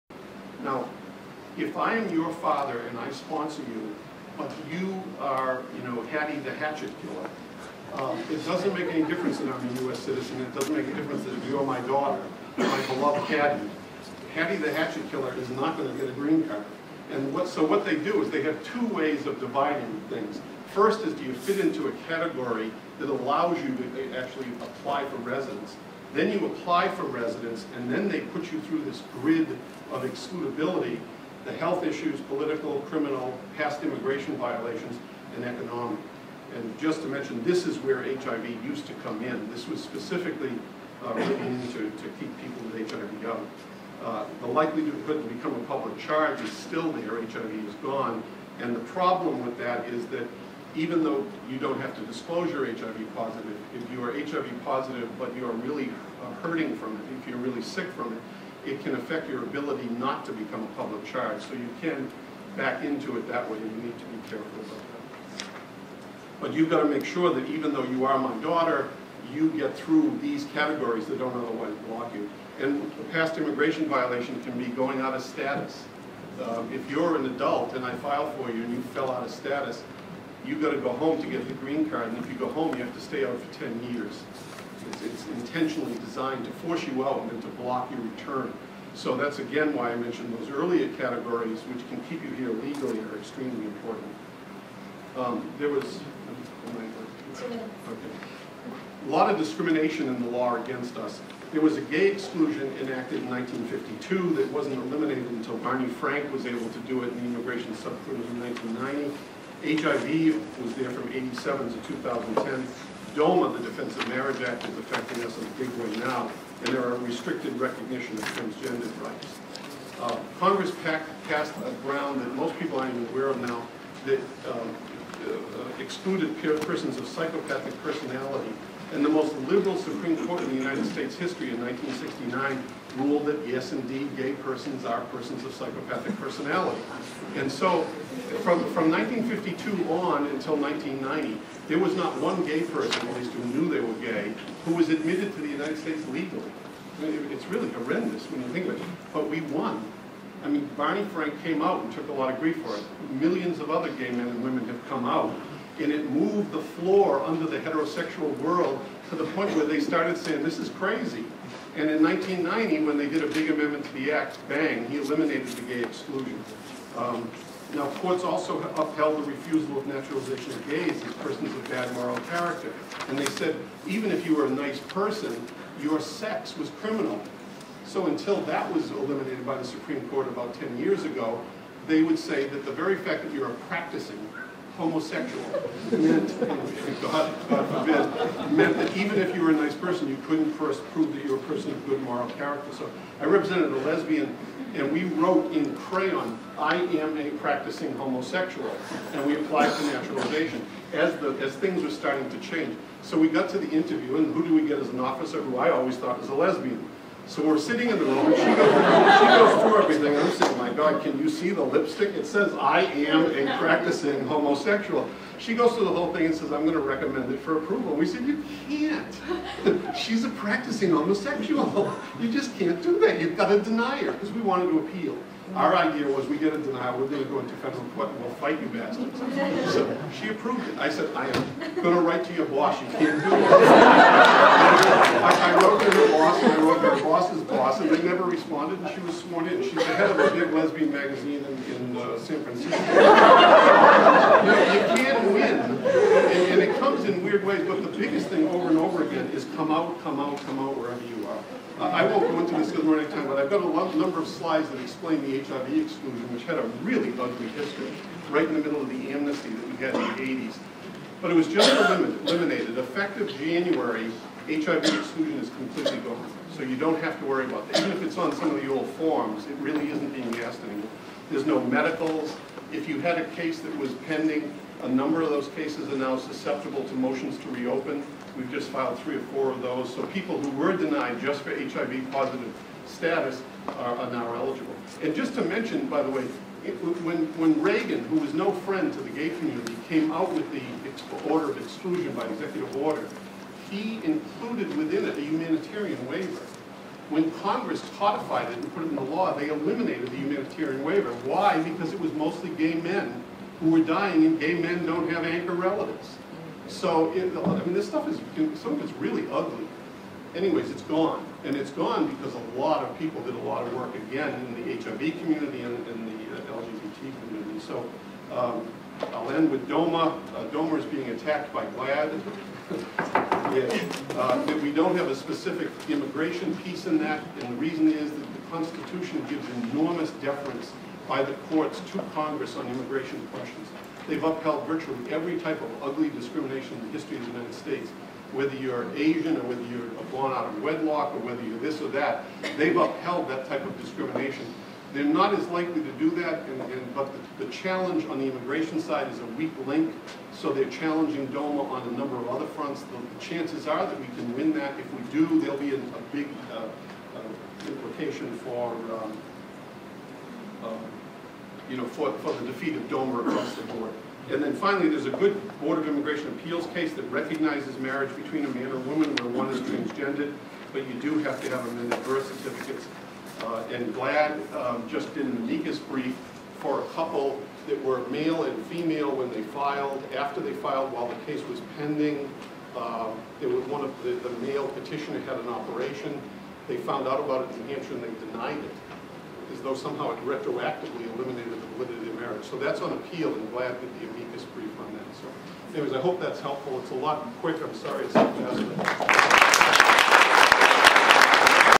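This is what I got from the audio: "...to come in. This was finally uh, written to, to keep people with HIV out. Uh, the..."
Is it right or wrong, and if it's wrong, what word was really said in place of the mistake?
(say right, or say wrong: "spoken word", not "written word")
wrong: "specifically", not "finally".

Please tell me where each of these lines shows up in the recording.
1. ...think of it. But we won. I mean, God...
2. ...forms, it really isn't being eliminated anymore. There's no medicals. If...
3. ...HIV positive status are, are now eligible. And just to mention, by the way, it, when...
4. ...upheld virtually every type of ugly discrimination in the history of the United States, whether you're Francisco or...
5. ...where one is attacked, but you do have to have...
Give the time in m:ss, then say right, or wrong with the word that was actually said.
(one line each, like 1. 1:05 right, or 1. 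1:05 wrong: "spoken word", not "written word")
1. 2:28 wrong: "Barney", not "God"
2. 4:28 wrong: "asked", not "eliminated"
3. 4:41 right
4. 5:34 wrong: "Asian", not "Francisco"
5. 6:09 wrong: "transgendered", not "attacked".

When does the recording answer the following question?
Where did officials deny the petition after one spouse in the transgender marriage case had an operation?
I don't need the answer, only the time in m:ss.
6:27.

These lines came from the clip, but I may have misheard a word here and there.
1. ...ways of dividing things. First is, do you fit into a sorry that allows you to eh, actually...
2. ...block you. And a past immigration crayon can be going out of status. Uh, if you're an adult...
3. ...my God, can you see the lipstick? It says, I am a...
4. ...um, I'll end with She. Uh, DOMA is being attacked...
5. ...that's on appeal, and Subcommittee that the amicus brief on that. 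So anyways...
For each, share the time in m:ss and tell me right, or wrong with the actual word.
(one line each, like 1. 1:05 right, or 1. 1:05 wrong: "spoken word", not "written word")
1. 0:18 wrong: "category", not "sorry"
2. 1:11 wrong: "violation", not "crayon"
3. 3:30 right
4. 5:18 wrong: "DOMA", not "She"
5. 6:32 wrong: "GLAD", not "Subcommittee".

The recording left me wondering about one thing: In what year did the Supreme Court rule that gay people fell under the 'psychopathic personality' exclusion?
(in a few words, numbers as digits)
1969.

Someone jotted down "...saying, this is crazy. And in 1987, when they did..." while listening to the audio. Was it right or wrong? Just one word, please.
wrong.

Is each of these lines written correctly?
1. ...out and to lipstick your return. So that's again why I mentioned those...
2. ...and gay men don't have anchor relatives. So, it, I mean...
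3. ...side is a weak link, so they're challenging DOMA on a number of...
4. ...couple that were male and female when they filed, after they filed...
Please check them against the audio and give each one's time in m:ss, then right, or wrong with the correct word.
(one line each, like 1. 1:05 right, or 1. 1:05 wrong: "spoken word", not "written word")
1. 1:27 wrong: "block", not "lipstick"
2. 5:04 right
3. 5:48 right
4. 6:16 right.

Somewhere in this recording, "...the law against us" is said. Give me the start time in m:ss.
1:40.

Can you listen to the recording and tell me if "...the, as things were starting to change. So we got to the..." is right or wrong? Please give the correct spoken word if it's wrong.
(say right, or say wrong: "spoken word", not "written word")
right.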